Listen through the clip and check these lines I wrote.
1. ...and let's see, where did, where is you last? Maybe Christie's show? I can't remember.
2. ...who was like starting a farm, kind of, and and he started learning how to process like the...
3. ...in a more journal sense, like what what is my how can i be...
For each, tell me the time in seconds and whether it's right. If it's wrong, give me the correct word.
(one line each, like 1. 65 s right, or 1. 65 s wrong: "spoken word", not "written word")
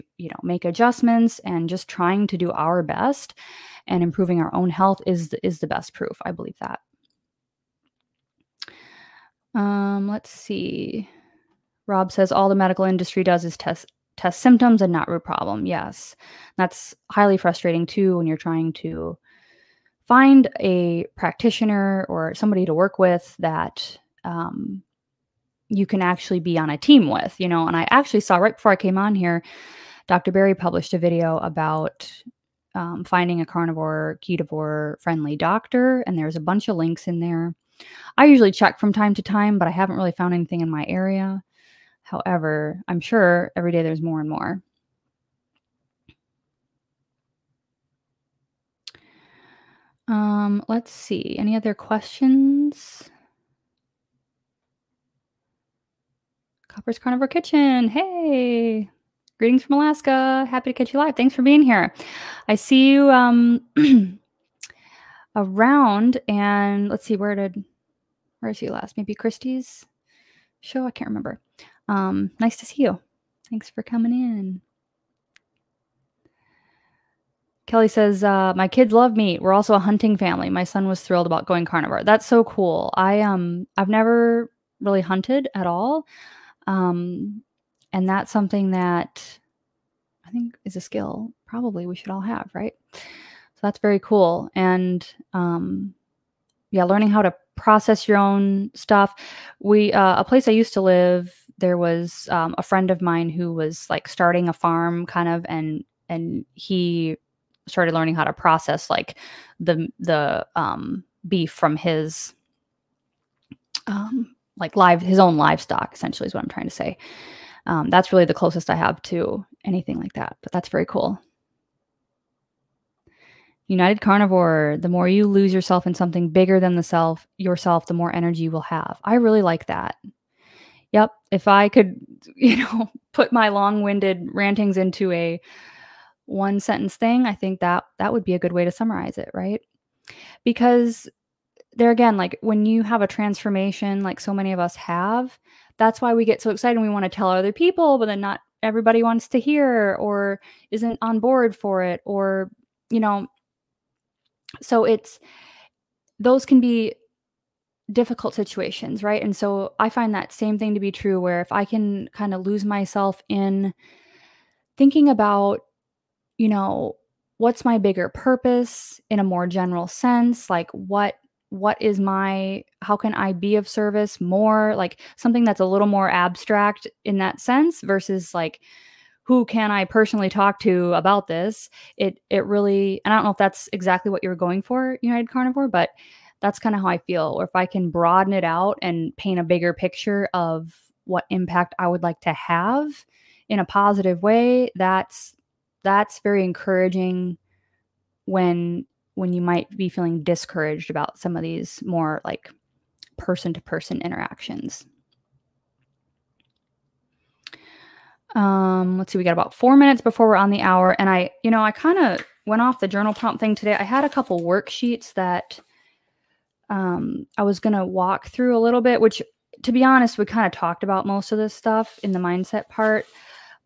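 1. 66 s right
2. 103 s right
3. 169 s wrong: "general", not "journal".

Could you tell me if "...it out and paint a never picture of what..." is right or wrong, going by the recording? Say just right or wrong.
wrong.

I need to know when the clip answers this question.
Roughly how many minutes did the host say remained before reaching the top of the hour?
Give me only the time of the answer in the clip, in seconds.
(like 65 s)
209 s.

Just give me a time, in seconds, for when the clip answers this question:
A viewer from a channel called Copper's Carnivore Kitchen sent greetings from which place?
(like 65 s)
59 s.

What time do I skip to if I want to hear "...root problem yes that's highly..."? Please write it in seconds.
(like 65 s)
15 s.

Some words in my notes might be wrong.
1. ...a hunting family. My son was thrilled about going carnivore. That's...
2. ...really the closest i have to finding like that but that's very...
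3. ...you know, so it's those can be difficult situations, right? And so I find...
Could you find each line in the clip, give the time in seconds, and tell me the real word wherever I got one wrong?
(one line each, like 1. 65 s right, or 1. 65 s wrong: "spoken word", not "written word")
1. 79 s right
2. 118 s wrong: "anything", not "finding"
3. 152 s right.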